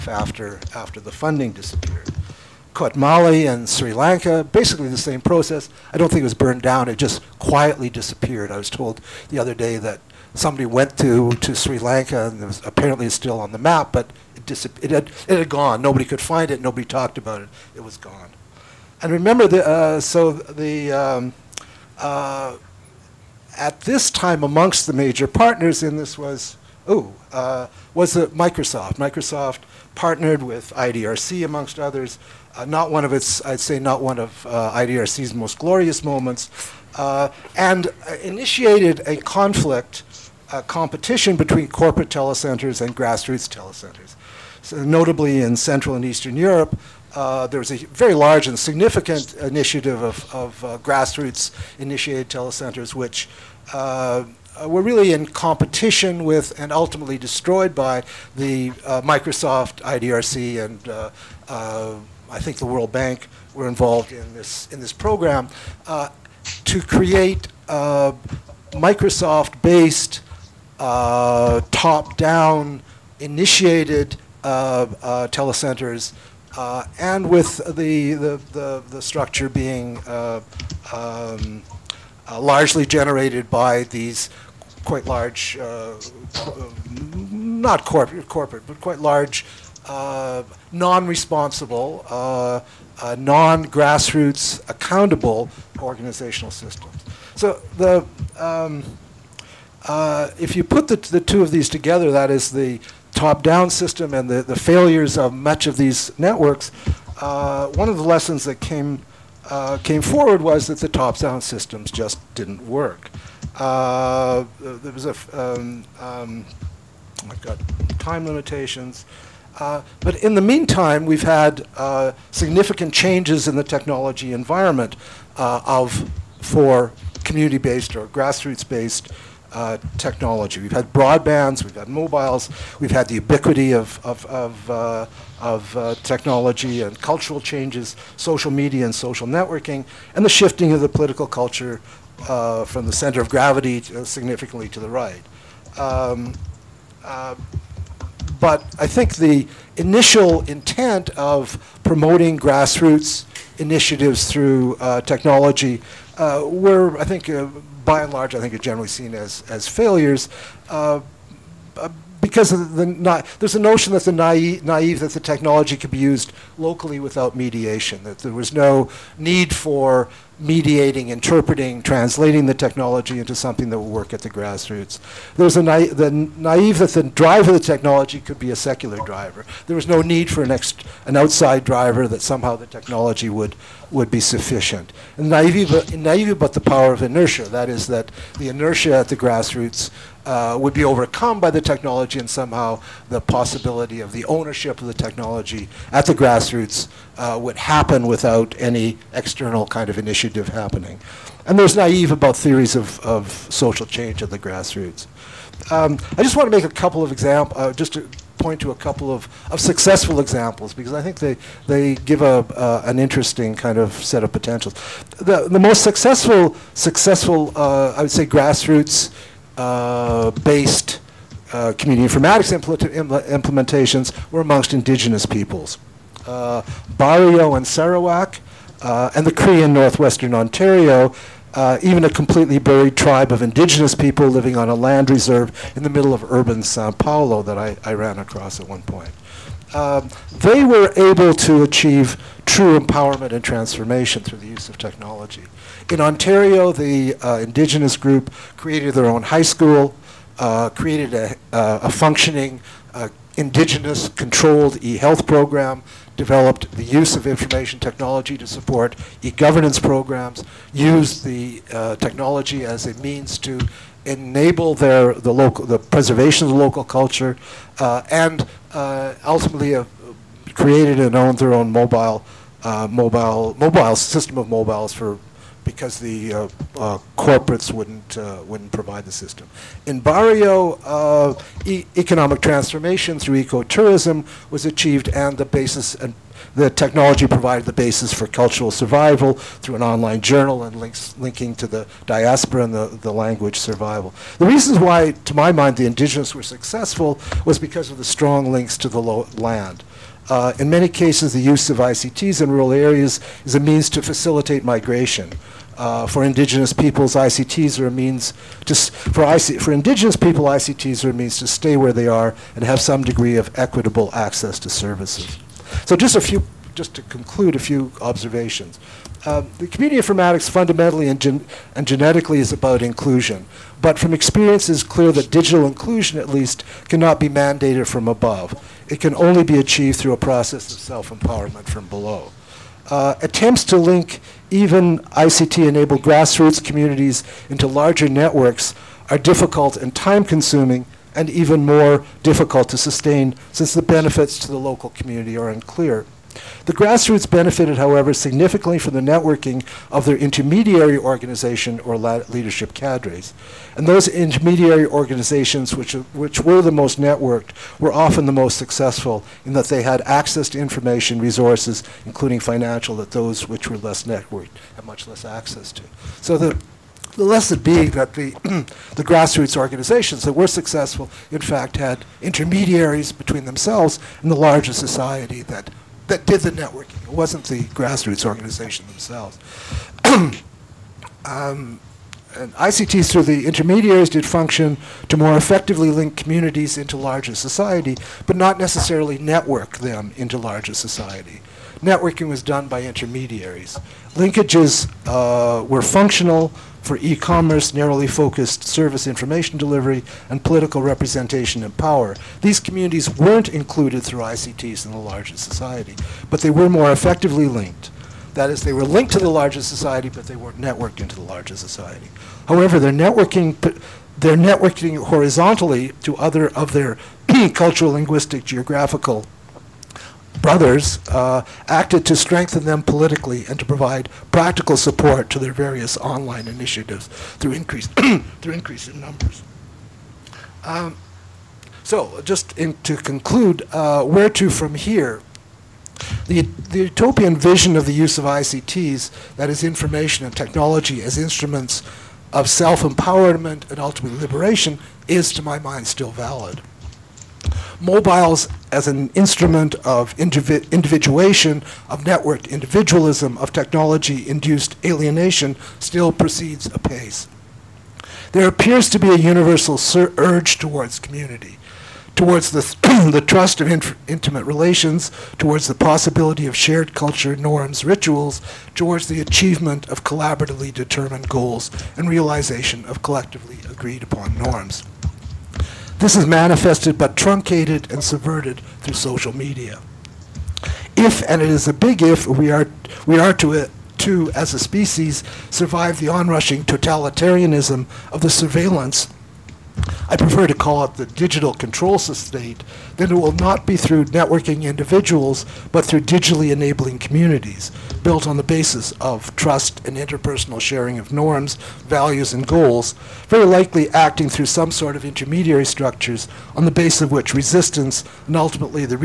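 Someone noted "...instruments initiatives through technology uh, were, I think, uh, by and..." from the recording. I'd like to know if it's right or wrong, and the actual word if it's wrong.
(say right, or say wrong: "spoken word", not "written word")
wrong: "grassroots", not "instruments".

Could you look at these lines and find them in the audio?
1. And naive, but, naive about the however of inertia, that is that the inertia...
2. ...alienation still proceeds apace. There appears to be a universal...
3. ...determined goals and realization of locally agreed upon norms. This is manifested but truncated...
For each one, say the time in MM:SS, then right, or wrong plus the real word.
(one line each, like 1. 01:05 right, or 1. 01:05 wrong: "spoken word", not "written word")
1. 03:05 wrong: "power", not "however"
2. 07:34 right
3. 07:50 wrong: "collectively", not "locally".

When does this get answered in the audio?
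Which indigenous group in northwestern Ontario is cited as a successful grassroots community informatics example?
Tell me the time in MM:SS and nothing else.
03:49.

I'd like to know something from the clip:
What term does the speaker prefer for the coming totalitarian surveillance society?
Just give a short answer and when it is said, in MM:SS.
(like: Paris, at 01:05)
The digital control state, at 08:10.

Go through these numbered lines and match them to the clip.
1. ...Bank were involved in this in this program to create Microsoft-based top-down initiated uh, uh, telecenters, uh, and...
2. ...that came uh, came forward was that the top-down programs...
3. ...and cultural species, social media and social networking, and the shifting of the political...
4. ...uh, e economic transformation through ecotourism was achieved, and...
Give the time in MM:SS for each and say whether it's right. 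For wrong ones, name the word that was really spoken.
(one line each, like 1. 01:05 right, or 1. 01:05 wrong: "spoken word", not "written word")
1. 01:02 right
2. 01:48 wrong: "systems", not "programs"
3. 02:16 wrong: "changes", not "species"
4. 04:40 right.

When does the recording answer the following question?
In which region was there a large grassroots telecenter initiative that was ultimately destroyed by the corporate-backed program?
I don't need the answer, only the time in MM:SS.
00:45.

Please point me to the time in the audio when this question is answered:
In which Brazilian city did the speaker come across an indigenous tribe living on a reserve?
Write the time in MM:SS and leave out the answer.
03:56.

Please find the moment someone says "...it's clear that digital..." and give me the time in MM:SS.
05:24.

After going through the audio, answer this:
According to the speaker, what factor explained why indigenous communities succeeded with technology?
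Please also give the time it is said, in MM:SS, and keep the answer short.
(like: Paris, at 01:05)
Strong links to the land, at 04:58.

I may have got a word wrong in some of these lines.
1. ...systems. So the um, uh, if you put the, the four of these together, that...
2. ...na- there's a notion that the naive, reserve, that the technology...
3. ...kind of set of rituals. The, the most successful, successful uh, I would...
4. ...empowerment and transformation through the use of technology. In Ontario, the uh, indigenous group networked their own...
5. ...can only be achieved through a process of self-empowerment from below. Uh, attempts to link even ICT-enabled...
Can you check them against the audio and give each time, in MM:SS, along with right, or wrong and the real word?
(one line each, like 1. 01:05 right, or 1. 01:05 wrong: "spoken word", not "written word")
1. 01:36 wrong: "two", not "four"
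2. 02:42 wrong: "naive", not "reserve"
3. 03:33 wrong: "potentials", not "rituals"
4. 04:02 wrong: "created", not "networked"
5. 05:28 right.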